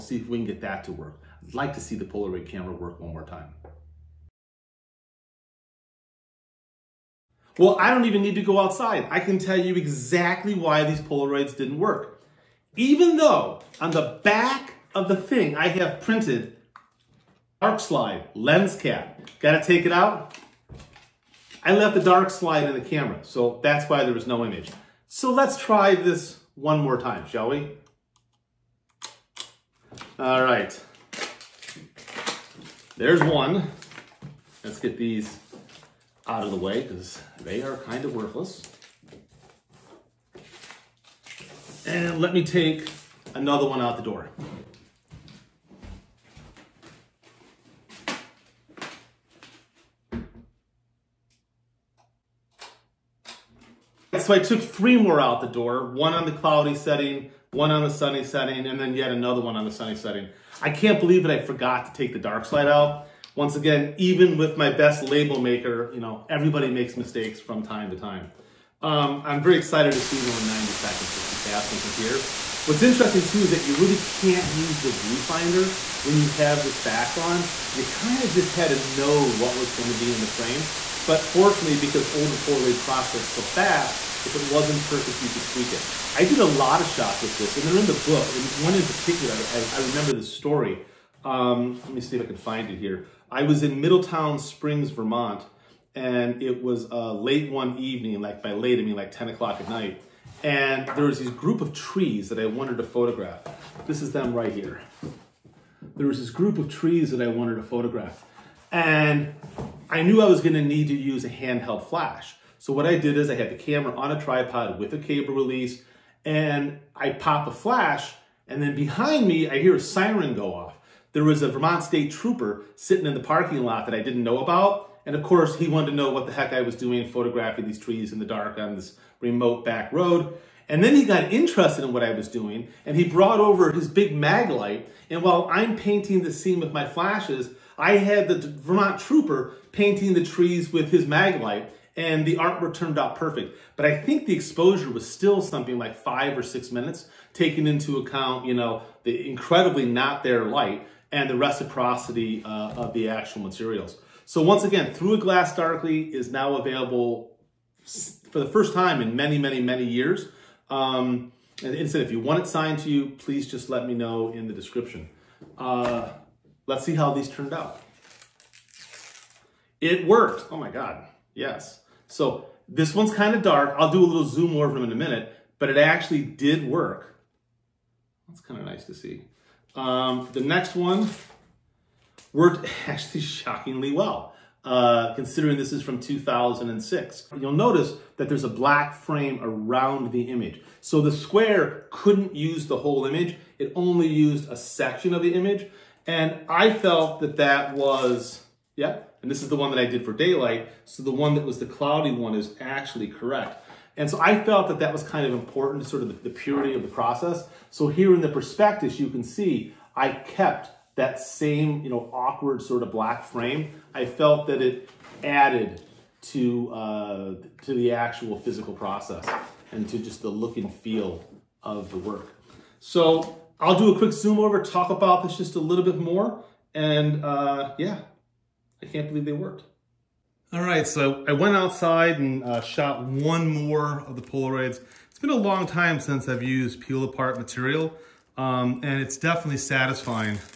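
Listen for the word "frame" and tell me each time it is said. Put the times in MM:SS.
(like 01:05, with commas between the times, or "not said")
01:20, 03:08, 03:33.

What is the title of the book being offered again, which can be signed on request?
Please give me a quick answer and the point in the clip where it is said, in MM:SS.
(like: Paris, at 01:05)
Through a Glass Darkly, at 02:34.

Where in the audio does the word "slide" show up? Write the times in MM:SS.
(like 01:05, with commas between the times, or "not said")
00:17, 00:22, 01:02.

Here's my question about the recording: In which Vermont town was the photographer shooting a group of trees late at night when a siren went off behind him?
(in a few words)
Middletown Springs.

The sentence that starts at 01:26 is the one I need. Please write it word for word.
I did a lot of shots with this, and they're in the book.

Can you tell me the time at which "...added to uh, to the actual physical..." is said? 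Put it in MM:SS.
03:35.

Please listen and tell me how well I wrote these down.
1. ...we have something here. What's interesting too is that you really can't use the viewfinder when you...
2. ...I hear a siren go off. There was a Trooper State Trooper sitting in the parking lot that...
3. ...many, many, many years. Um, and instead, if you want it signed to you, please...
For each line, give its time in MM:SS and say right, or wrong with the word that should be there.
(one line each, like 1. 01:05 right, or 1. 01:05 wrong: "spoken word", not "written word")
1. 01:11 right
2. 01:59 wrong: "Vermont", not "Trooper"
3. 02:39 right.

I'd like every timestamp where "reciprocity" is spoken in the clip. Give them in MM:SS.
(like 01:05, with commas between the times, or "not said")
02:31.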